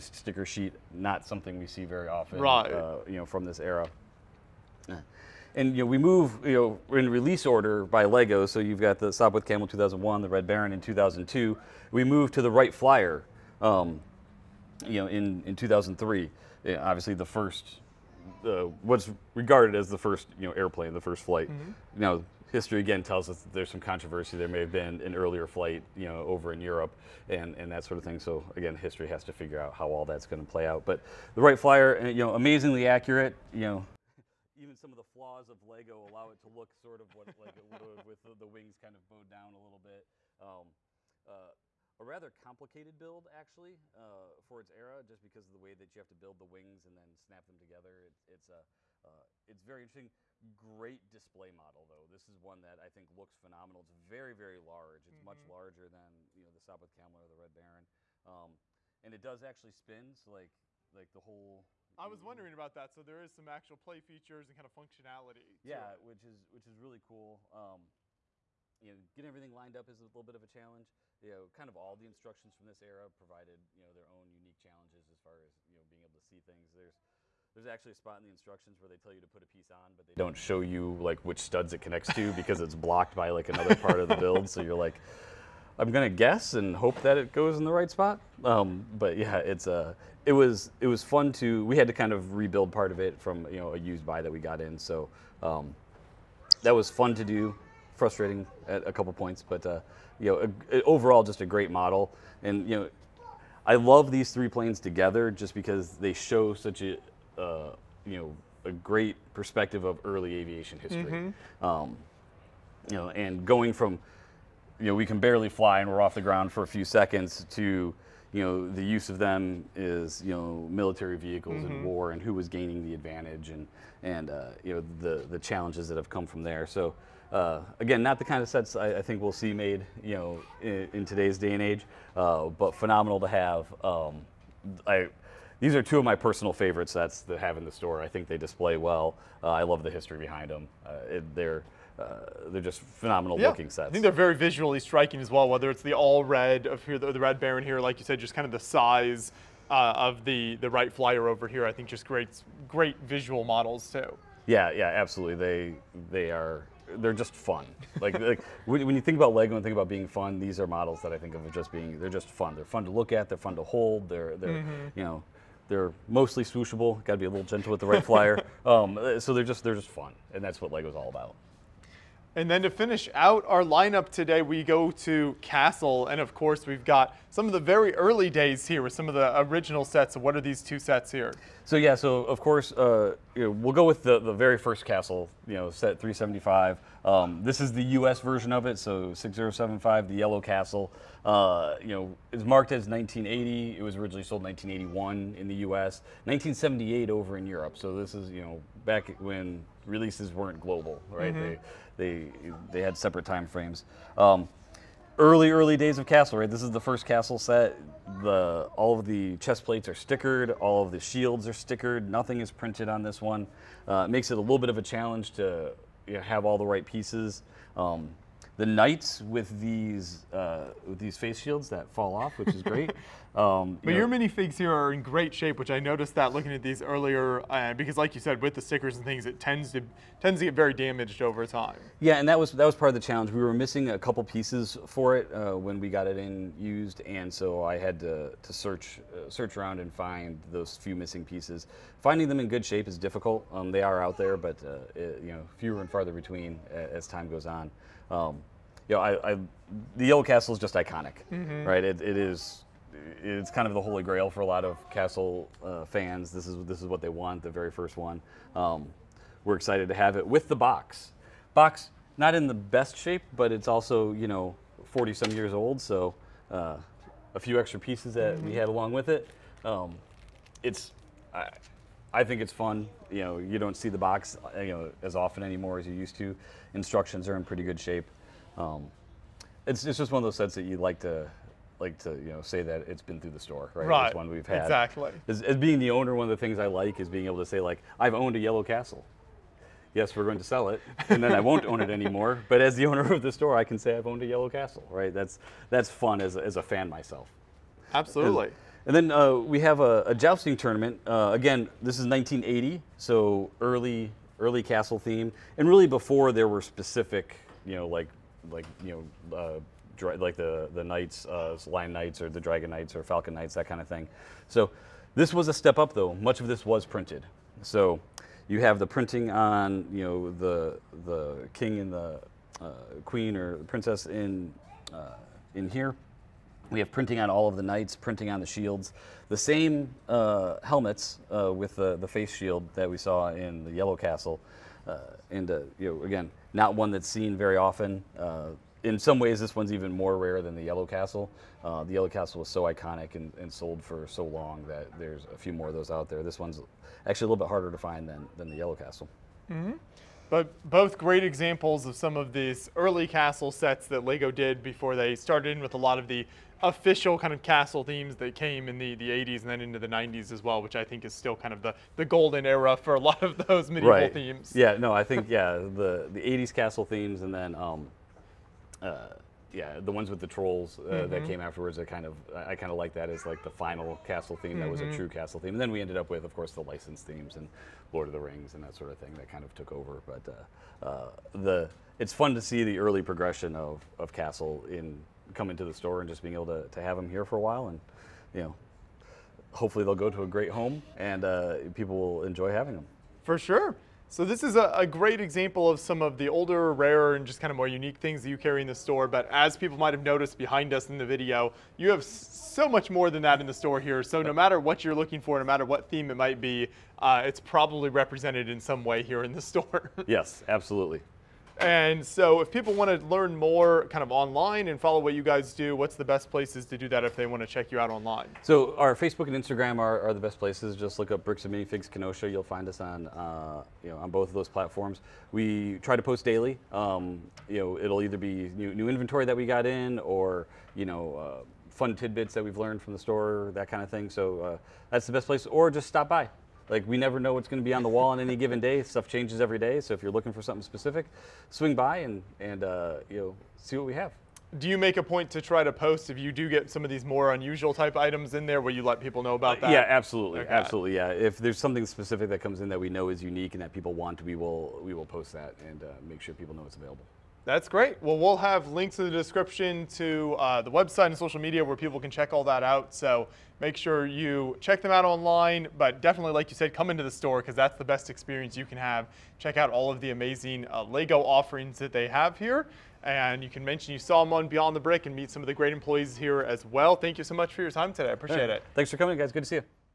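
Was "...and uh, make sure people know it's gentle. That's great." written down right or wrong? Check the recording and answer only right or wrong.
wrong.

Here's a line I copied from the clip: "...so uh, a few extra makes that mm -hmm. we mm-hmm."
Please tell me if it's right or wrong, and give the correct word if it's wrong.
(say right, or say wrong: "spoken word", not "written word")
wrong: "pieces", not "makes".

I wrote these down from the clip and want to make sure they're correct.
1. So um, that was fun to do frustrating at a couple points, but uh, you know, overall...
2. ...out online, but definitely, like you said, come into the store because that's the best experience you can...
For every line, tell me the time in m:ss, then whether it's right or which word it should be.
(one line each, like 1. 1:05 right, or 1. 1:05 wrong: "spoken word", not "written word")
1. 1:34 right
2. 7:44 right.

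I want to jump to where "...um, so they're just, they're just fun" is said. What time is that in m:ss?
2:48.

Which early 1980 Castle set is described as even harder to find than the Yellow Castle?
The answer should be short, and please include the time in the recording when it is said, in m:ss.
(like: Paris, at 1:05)
Jousting tournament, at 5:00.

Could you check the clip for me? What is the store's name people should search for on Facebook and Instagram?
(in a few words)
Bricks and Minifigs Kenosha.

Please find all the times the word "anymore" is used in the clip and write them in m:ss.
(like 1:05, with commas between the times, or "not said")
4:35, 4:51.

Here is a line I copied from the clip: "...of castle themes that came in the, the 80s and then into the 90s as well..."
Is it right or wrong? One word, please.
right.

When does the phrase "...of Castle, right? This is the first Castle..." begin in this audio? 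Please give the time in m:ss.
3:25.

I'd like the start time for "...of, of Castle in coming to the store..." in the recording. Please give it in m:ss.
6:23.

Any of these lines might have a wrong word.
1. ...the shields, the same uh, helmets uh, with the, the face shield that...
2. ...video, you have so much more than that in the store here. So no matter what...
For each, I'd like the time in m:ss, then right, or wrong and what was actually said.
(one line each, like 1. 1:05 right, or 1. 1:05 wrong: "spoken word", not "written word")
1. 5:28 right
2. 6:41 right.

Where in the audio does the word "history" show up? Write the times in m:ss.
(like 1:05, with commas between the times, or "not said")
0:22, 0:28, 1:50, 2:19.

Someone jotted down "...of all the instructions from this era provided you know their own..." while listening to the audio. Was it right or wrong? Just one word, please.
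right.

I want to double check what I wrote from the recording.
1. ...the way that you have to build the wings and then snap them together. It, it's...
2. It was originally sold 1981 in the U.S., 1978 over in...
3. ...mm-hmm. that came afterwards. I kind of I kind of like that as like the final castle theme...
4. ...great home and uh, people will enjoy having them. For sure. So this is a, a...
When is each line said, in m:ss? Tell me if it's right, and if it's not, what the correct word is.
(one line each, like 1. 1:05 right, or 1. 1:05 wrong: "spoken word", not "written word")
1. 0:45 right
2. 3:13 right
3. 6:10 right
4. 6:30 right.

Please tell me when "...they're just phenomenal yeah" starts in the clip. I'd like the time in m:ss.
2:22.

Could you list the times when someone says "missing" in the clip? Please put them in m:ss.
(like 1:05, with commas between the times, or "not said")
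3:53, 4:00.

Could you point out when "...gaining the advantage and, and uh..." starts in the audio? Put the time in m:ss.
2:02.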